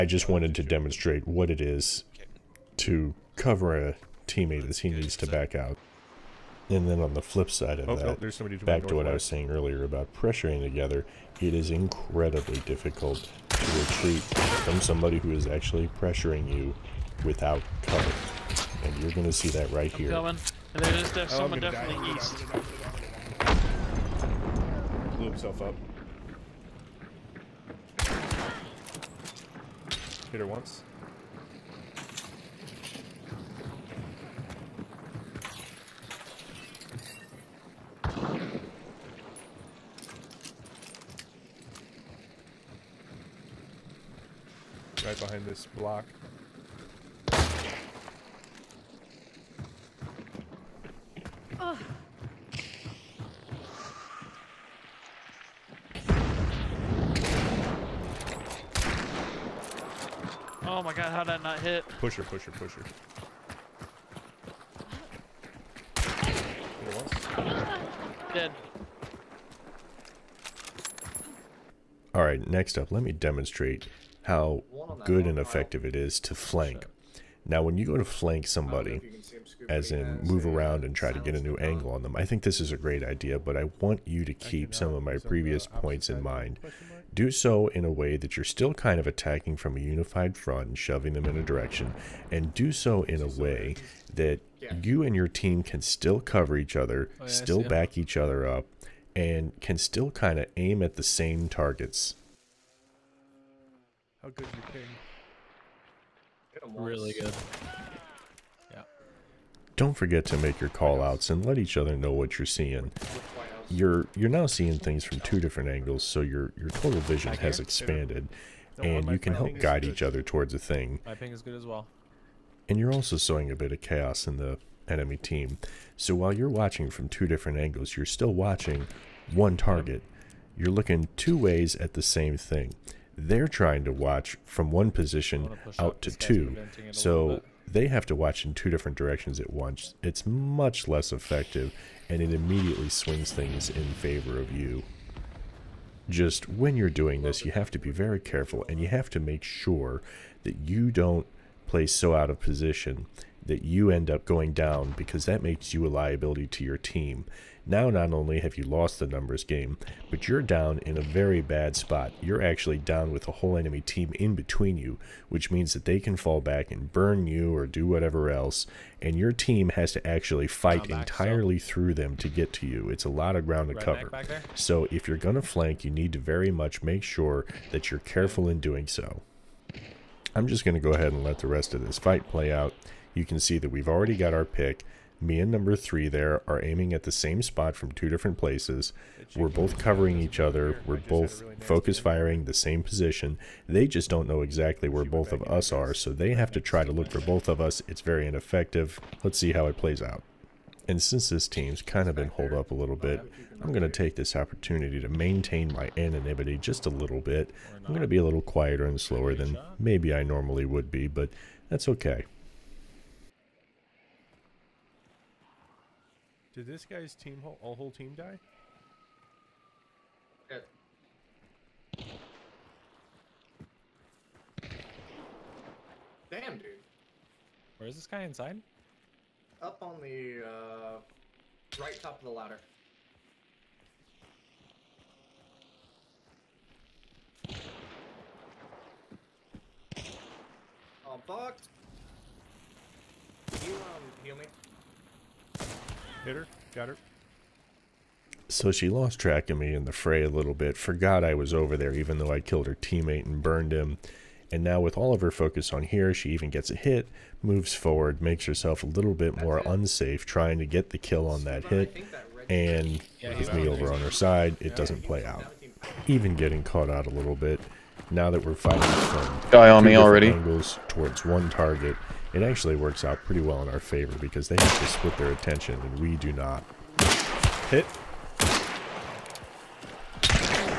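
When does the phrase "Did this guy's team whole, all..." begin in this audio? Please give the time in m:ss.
3:36.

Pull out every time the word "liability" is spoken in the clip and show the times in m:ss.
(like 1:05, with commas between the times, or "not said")
2:35.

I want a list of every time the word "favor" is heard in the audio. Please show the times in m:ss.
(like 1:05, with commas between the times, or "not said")
2:23, 4:33.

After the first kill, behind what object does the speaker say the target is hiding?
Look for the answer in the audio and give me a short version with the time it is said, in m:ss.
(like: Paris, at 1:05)
Block, at 0:45.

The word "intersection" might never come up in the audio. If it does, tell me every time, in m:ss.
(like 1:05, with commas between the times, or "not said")
not said.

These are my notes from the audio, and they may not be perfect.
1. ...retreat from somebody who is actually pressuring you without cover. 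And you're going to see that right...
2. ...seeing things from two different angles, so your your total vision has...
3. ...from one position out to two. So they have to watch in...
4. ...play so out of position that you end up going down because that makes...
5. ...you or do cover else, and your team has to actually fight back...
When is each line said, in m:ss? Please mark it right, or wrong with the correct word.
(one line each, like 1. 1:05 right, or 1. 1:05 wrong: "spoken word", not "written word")
1. 0:13 right
2. 1:54 right
3. 2:14 right
4. 2:31 right
5. 2:47 wrong: "whatever", not "cover".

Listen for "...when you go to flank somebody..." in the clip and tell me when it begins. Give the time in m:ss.
1:17.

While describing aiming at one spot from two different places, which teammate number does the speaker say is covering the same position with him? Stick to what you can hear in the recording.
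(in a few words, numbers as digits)
3.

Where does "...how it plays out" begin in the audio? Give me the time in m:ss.
3:19.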